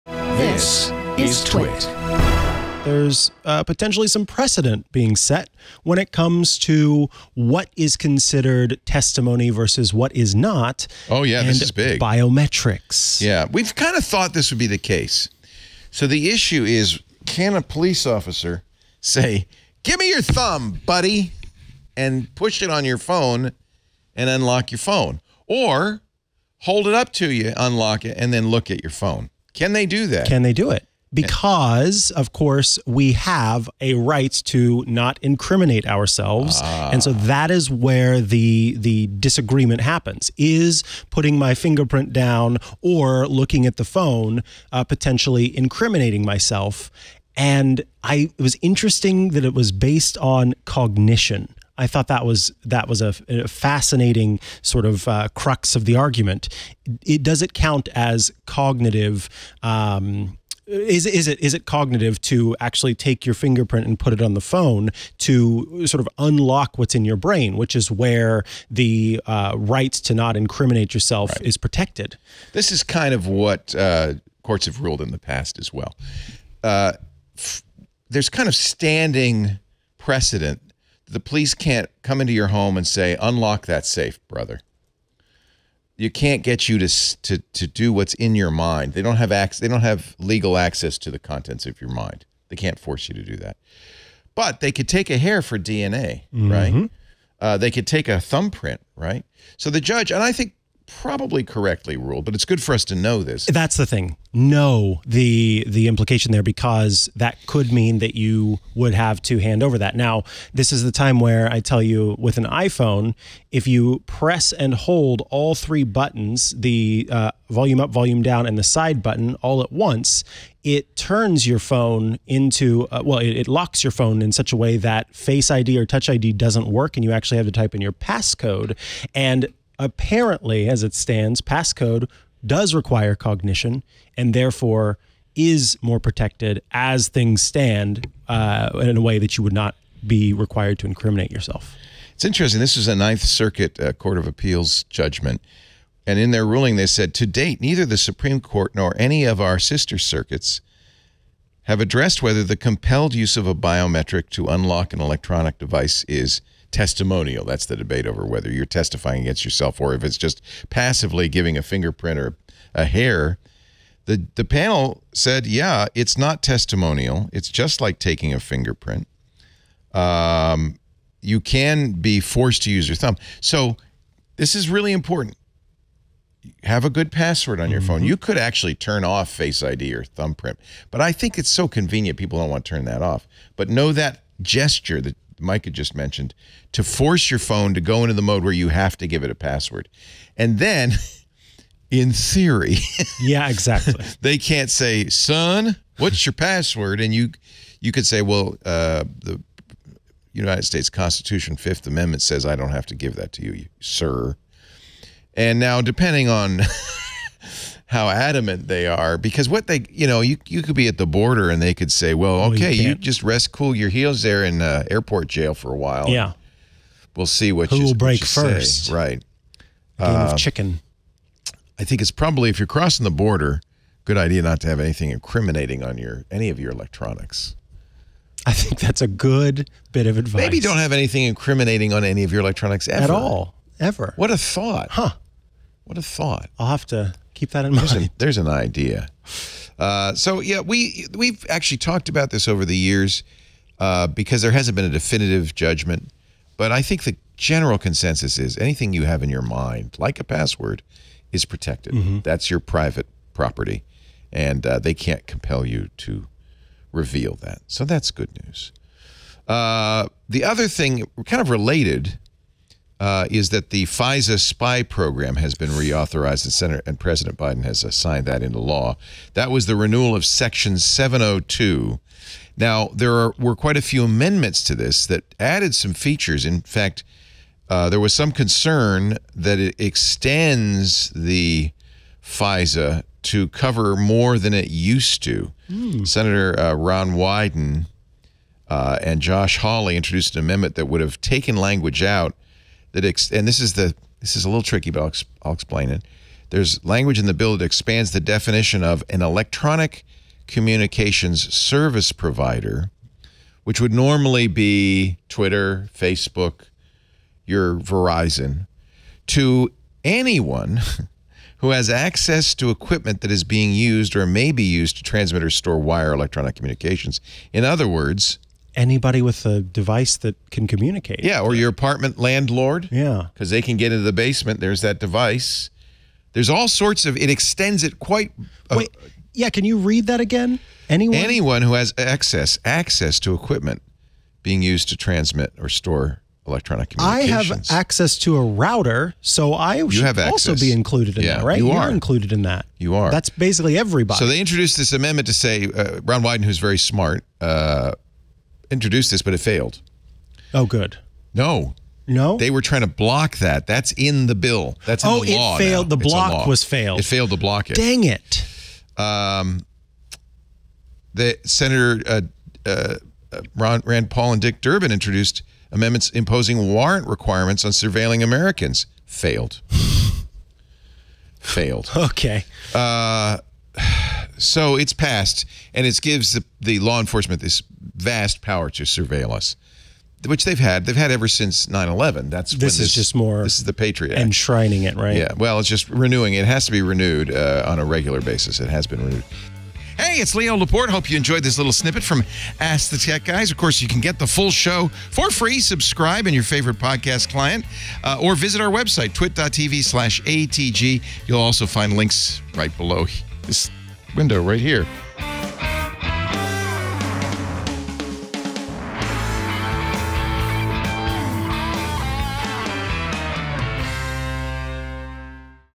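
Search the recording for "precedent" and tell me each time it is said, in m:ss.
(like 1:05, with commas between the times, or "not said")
0:04, 1:19.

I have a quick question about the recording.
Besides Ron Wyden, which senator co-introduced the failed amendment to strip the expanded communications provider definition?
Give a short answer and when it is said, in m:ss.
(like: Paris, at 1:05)
Josh Hawley, at 4:49.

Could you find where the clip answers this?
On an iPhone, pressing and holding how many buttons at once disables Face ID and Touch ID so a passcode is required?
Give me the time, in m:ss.
1:55.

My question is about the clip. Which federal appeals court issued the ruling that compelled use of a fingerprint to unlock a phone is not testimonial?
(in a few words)
Ninth Circuit.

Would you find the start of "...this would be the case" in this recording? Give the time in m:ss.
0:14.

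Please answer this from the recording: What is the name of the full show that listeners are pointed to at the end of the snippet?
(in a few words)
Ask the Tech Guys.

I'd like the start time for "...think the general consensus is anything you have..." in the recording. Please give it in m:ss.
4:06.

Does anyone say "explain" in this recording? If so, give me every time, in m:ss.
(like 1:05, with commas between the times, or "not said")
4:55.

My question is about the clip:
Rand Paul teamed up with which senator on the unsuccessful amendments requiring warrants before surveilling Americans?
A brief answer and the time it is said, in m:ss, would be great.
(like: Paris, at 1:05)
Dick Durbin, at 6:04.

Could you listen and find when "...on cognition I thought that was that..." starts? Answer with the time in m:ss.
0:50.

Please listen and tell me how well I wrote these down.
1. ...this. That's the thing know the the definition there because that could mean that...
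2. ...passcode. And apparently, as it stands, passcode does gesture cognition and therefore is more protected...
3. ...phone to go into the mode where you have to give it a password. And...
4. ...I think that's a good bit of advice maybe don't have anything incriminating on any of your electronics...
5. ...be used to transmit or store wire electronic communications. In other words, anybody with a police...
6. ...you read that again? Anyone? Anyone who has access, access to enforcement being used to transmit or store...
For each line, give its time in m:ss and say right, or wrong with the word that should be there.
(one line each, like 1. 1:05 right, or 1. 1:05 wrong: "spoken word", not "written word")
1. 1:43 wrong: "implication", not "definition"
2. 2:07 wrong: "require", not "gesture"
3. 3:07 right
4. 3:48 right
5. 5:14 wrong: "device", not "police"
6. 5:29 wrong: "equipment", not "enforcement".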